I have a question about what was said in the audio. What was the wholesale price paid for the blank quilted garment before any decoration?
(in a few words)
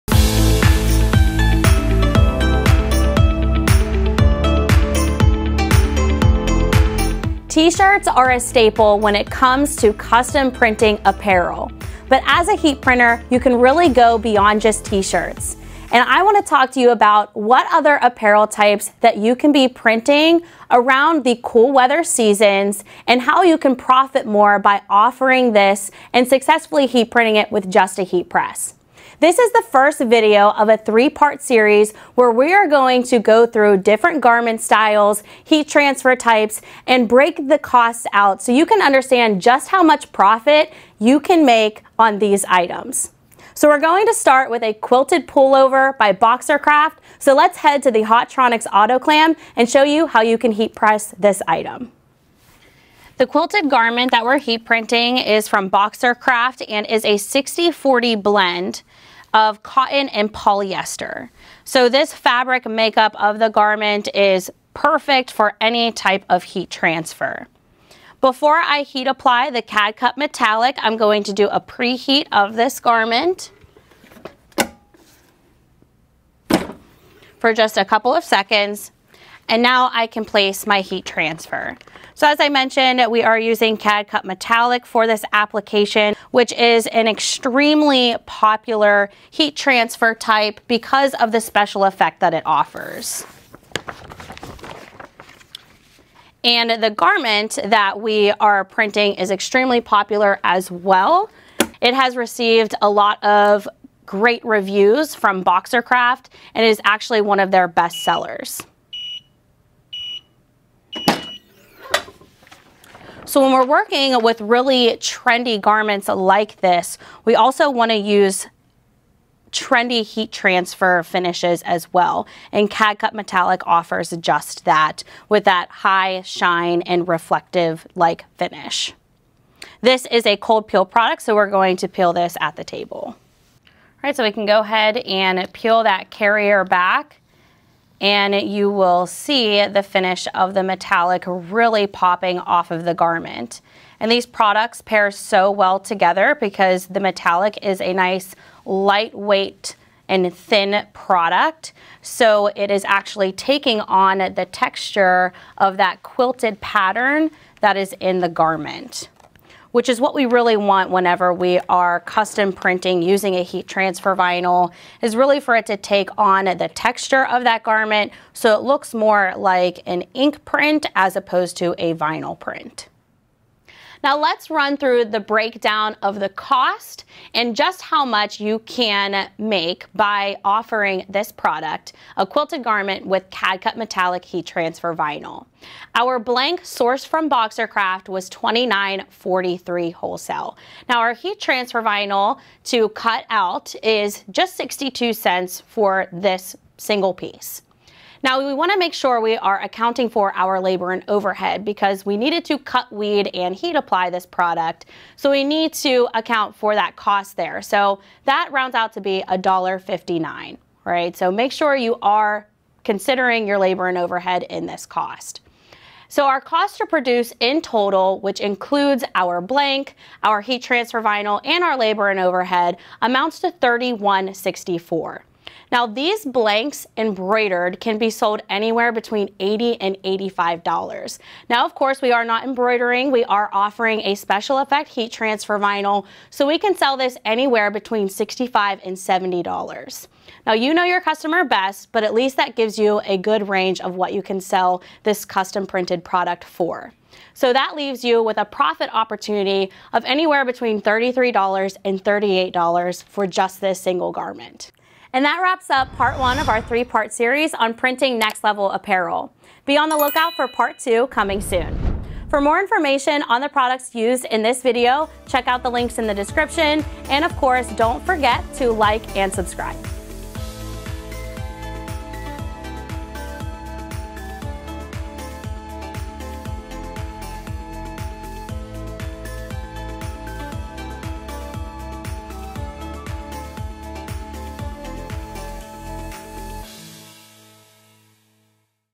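$29.43.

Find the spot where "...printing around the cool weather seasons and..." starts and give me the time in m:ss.
0:19.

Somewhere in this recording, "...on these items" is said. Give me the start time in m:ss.
0:41.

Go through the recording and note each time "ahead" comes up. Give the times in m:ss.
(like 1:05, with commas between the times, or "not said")
2:14.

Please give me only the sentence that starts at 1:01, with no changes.
So this fabric makeup of the garment is perfect for any type of heat transfer.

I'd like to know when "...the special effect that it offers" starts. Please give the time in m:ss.
1:31.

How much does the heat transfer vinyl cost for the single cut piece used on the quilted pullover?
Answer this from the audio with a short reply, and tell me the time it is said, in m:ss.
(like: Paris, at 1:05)
62 cents, at 3:14.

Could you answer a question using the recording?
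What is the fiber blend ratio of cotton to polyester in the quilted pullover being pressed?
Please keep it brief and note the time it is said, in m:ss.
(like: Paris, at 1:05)
60-40, at 0:57.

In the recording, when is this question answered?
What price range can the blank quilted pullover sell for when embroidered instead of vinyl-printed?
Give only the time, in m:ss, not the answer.
3:48.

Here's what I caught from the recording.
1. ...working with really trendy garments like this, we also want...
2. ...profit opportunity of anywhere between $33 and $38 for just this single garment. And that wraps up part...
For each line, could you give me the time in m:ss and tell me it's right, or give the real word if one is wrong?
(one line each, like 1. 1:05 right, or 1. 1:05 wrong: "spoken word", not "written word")
1. 1:53 right
2. 4:08 right.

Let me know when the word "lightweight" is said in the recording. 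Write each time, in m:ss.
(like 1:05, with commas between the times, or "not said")
2:28.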